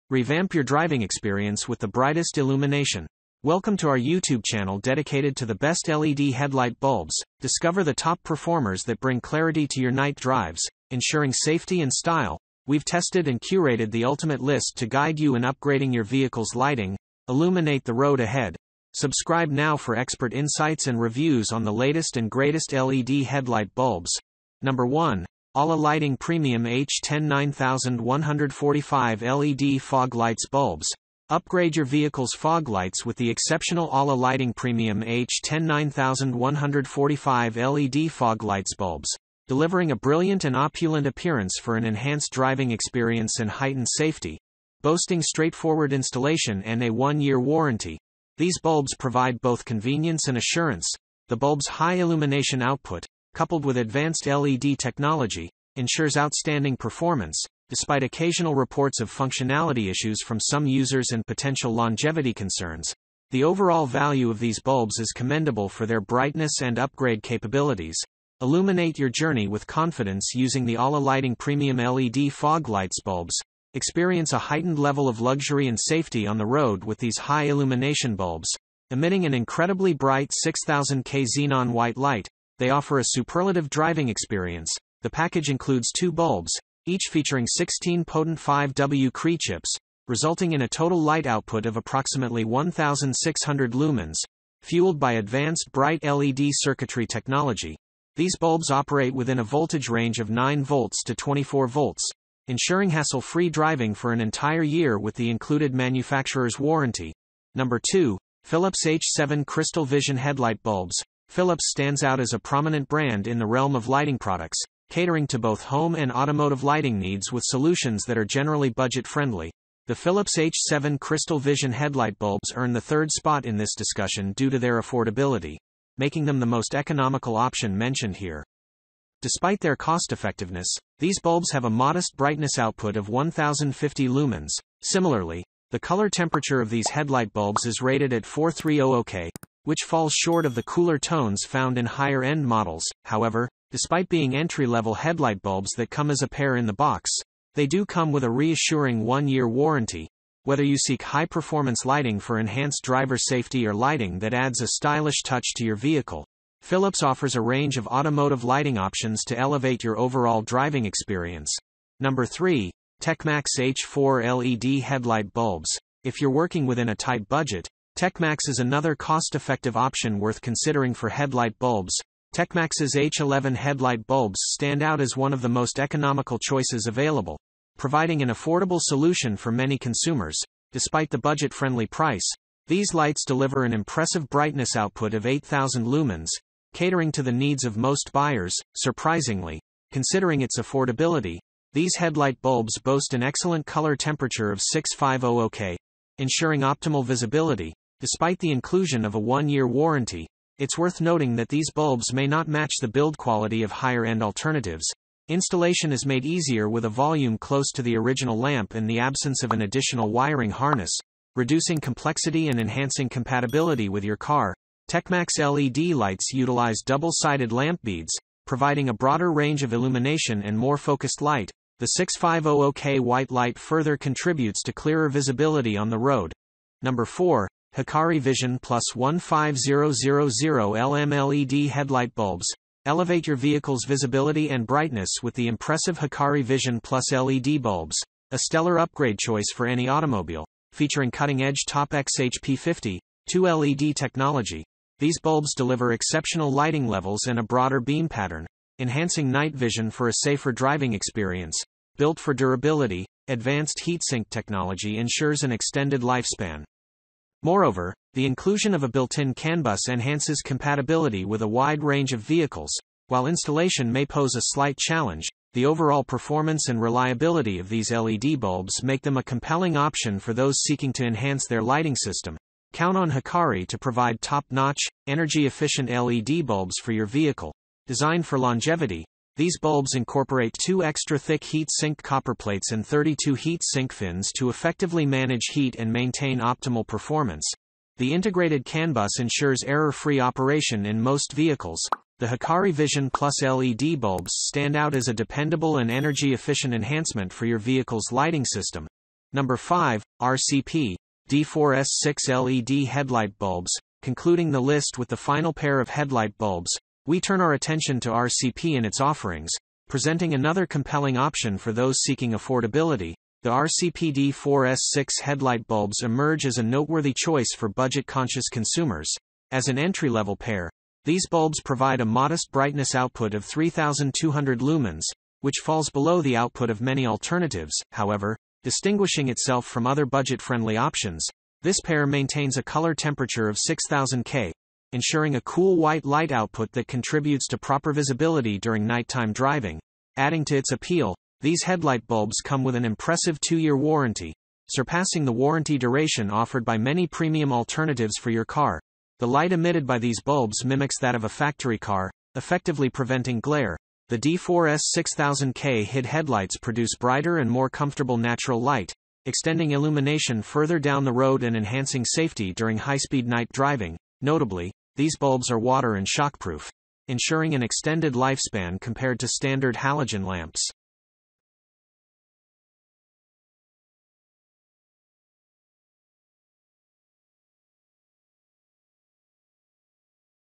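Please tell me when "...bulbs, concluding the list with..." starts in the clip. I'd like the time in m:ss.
5:03.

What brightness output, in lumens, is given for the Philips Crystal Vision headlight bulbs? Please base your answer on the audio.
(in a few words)
1050.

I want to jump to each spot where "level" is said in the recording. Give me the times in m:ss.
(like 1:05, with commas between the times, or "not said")
1:14, 2:24, 4:06, 5:20.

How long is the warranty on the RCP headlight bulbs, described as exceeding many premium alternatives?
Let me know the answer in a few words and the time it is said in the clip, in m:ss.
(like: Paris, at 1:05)
2 years, at 5:43.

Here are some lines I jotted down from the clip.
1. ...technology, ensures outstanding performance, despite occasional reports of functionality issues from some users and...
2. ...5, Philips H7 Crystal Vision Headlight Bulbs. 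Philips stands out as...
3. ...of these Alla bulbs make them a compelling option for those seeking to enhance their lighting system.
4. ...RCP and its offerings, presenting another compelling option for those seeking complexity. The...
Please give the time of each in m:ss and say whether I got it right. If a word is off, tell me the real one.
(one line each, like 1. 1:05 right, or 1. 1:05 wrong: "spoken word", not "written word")
1. 0:54 right
2. 1:47 wrong: "2", not "5"
3. 4:27 wrong: "LED", not "Alla"
4. 5:08 wrong: "affordability", not "complexity".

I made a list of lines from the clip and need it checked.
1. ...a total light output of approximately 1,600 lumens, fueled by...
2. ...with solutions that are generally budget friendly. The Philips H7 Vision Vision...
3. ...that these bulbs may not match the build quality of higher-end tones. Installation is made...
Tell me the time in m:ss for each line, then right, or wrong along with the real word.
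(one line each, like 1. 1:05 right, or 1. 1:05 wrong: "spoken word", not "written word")
1. 1:30 right
2. 1:57 wrong: "Crystal", not "Vision"
3. 3:21 wrong: "alternatives", not "tones".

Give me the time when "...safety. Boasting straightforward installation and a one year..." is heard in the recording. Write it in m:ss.
0:43.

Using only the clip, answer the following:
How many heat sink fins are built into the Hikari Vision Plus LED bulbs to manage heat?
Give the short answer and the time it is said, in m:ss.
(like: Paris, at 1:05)
32, at 4:42.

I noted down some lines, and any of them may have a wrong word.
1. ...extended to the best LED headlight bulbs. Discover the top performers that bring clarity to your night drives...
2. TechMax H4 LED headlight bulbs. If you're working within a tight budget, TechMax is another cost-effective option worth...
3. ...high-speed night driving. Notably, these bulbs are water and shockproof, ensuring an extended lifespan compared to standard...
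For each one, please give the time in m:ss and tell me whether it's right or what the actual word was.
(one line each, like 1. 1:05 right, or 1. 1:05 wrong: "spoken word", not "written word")
1. 0:04 wrong: "dedicated", not "extended"
2. 2:43 right
3. 6:02 right.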